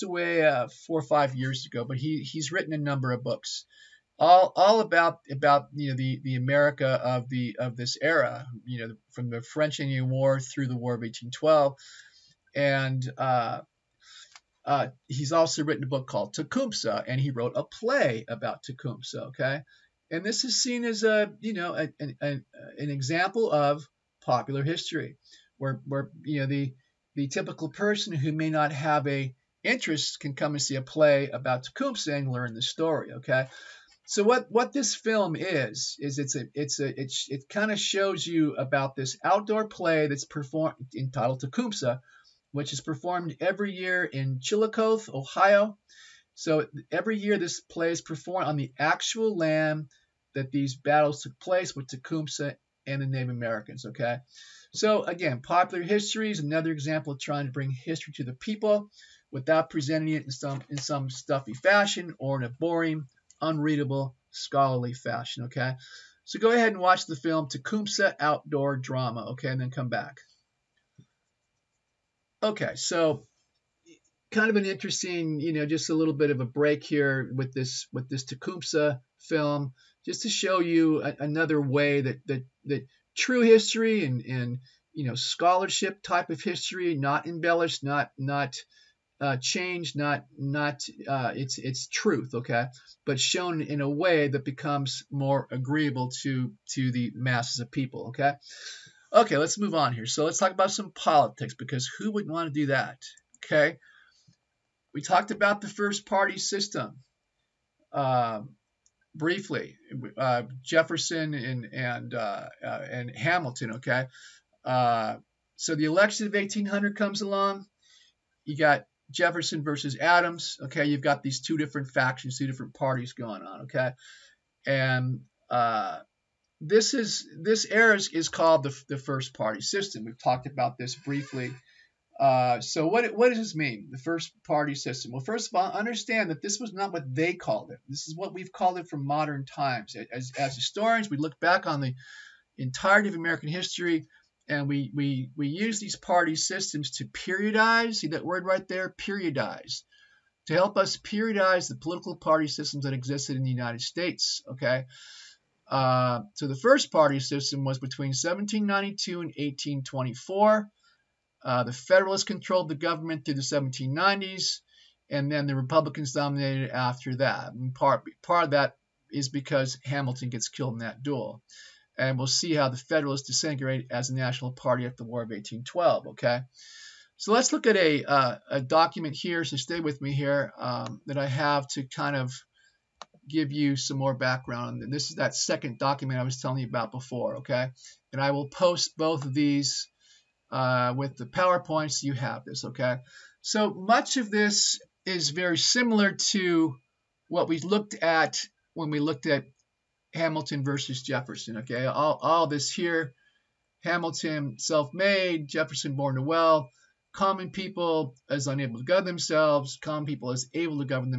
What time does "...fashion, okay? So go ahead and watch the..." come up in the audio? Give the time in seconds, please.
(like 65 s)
64 s.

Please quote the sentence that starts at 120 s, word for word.
Okay, you've got these two different factions, two different parties going on.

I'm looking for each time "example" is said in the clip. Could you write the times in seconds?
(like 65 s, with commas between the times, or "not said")
22 s, 56 s.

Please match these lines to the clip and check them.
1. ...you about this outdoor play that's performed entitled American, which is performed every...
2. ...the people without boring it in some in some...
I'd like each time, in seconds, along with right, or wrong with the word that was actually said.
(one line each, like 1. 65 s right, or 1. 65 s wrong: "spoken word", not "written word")
1. 38 s wrong: "Tecumseh", not "American"
2. 58 s wrong: "presenting", not "boring".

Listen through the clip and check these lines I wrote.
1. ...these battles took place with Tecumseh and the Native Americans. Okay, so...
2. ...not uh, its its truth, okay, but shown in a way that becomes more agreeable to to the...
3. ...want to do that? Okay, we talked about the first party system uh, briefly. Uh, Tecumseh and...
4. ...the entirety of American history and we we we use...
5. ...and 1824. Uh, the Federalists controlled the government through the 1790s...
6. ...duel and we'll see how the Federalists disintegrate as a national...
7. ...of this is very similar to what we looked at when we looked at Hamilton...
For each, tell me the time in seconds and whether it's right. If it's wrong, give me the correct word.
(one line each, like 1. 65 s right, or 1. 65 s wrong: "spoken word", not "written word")
1. 50 s right
2. 90 s right
3. 102 s wrong: "Jefferson", not "Tecumseh"
4. 141 s right
5. 159 s right
6. 171 s right
7. 194 s right.